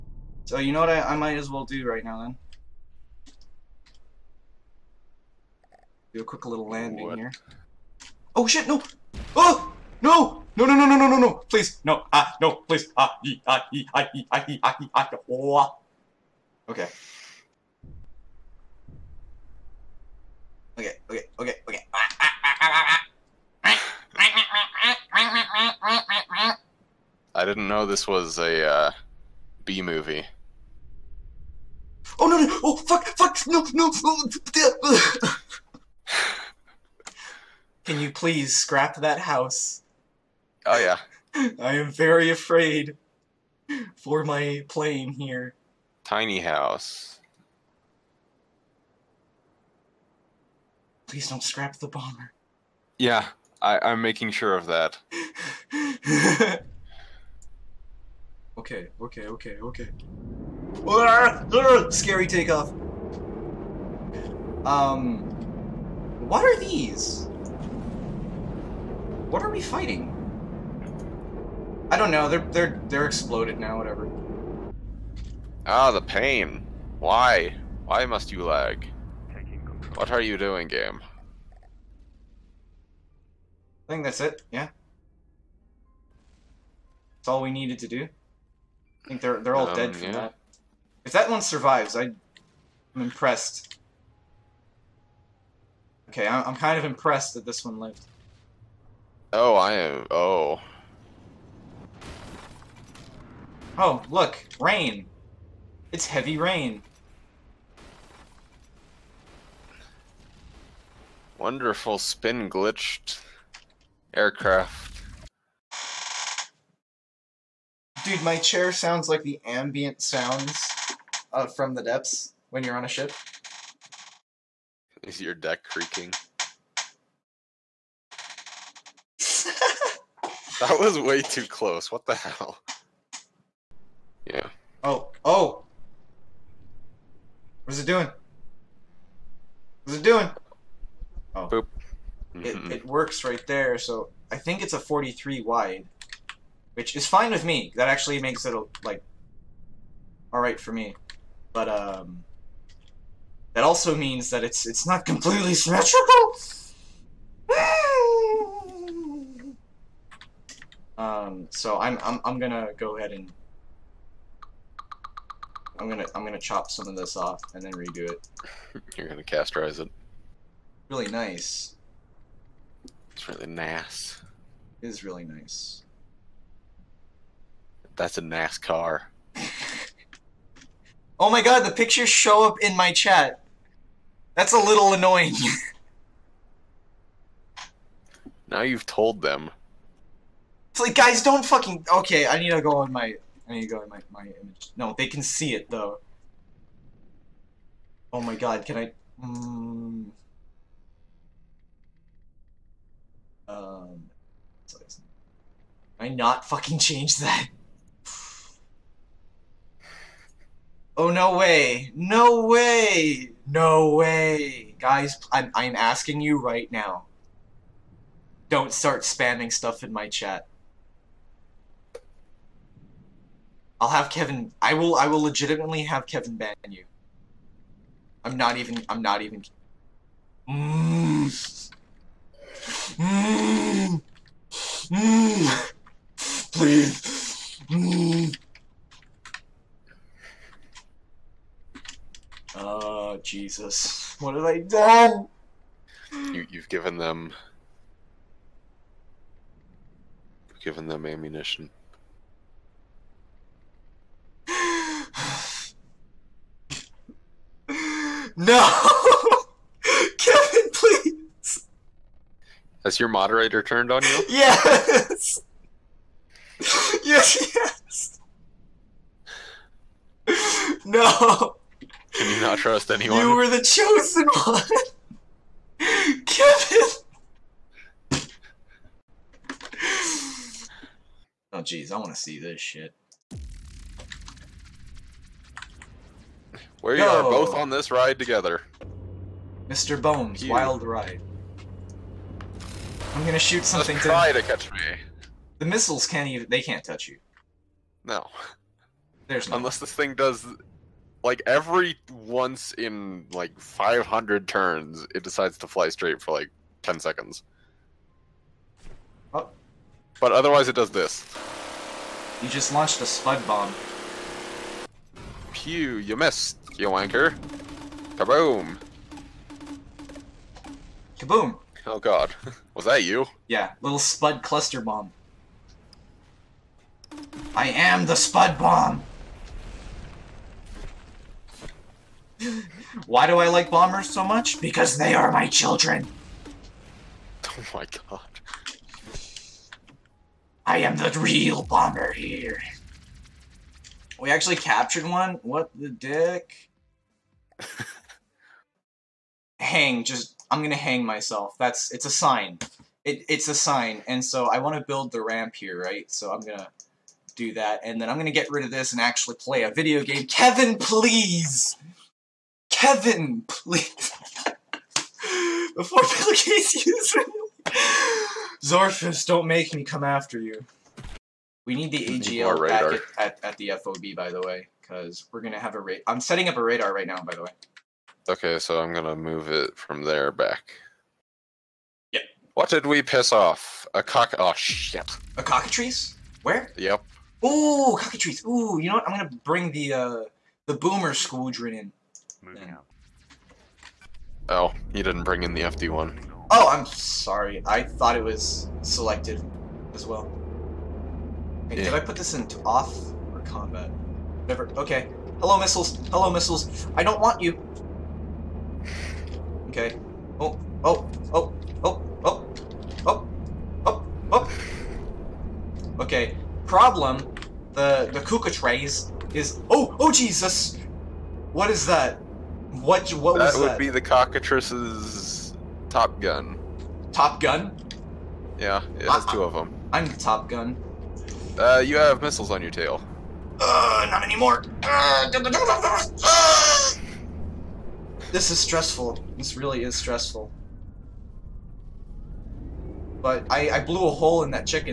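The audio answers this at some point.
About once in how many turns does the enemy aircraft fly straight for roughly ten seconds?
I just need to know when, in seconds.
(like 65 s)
303 s.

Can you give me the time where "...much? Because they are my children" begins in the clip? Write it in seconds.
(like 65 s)
334 s.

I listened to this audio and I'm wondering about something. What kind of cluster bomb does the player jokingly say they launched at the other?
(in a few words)
spud cluster bomb.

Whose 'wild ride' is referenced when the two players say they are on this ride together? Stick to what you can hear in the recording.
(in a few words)
Mr. Bones.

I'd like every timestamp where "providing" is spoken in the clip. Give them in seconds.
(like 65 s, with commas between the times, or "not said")
not said.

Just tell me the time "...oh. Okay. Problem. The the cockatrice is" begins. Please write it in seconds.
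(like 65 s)
414 s.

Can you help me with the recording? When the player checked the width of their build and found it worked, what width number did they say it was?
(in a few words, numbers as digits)
43.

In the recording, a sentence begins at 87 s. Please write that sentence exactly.
That's all we needed to do.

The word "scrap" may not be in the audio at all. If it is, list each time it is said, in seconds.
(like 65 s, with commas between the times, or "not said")
38 s, 51 s.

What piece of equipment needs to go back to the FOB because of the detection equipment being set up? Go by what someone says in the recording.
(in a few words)
AGL.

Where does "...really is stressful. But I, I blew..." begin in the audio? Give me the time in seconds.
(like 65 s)
439 s.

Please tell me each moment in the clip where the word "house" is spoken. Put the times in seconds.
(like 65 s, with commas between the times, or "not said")
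39 s, 46 s.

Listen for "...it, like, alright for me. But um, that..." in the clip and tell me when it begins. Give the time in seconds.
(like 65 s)
148 s.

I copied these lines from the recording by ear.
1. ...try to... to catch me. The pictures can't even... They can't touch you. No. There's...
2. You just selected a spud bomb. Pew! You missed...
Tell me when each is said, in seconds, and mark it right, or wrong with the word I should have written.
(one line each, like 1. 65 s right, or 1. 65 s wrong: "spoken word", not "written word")
1. 294 s wrong: "missiles", not "pictures"
2. 312 s wrong: "launched", not "selected".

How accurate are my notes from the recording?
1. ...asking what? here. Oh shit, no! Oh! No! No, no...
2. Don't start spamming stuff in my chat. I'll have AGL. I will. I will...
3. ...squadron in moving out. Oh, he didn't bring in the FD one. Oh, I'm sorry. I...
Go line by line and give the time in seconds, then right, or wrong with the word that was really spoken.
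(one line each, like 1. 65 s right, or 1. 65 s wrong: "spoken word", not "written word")
1. 6 s wrong: "landing", not "asking"
2. 218 s wrong: "Kevin", not "AGL"
3. 391 s right.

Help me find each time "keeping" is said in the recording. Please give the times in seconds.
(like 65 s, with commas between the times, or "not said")
not said.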